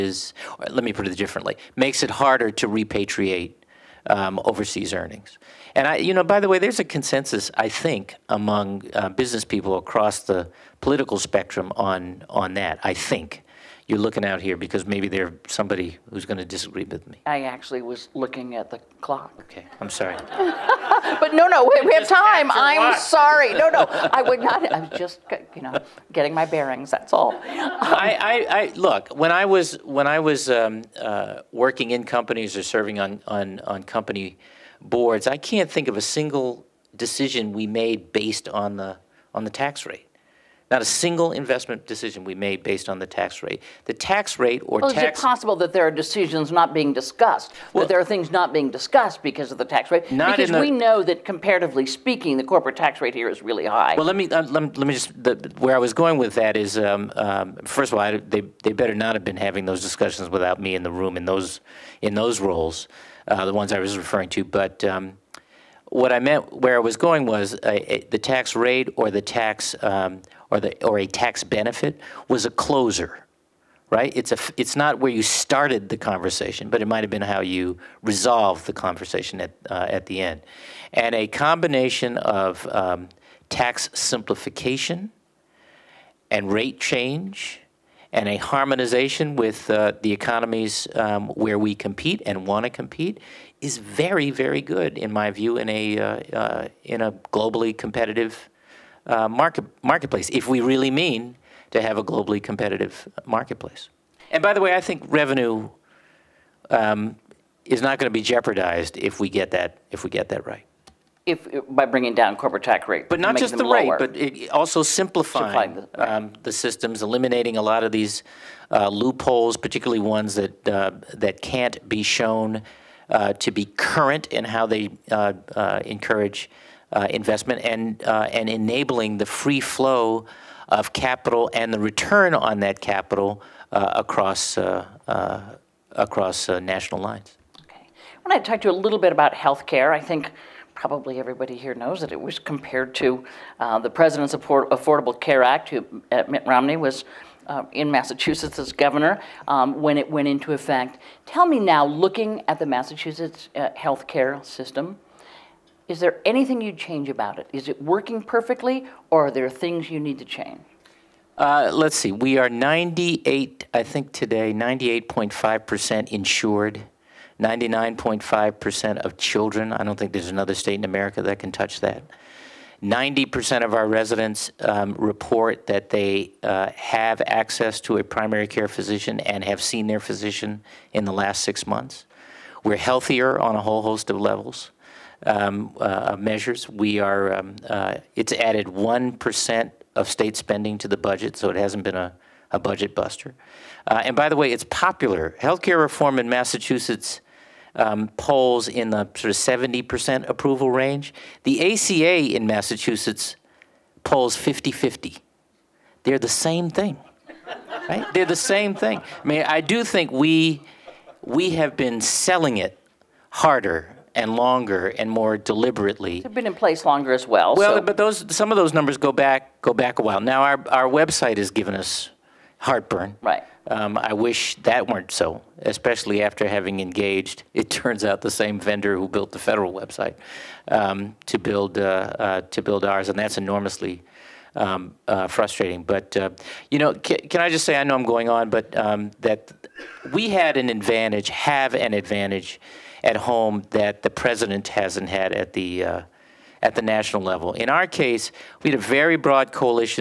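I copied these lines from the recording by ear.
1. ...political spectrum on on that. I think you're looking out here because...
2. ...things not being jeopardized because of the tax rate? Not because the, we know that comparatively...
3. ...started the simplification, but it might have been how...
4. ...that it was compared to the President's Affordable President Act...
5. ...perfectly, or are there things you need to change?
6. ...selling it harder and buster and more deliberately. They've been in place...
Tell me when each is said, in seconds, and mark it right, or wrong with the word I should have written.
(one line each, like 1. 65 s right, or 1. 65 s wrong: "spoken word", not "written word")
1. 10 s right
2. 48 s wrong: "discussed", not "jeopardized"
3. 75 s wrong: "conversation", not "simplification"
4. 141 s wrong: "Care", not "President"
5. 158 s right
6. 212 s wrong: "longer", not "buster".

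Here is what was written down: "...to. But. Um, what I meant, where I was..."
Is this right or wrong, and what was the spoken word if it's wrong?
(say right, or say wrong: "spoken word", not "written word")
right.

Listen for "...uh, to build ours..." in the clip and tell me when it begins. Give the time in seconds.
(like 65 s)
232 s.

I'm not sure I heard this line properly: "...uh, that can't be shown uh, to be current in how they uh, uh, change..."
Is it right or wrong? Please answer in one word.
wrong.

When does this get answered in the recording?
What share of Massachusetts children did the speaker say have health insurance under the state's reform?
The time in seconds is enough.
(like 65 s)
167 s.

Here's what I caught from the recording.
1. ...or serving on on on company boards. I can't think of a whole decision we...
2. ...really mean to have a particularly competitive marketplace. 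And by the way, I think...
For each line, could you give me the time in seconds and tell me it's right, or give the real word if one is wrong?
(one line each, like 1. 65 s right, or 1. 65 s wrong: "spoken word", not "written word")
1. 32 s wrong: "single", not "whole"
2. 100 s wrong: "globally", not "particularly".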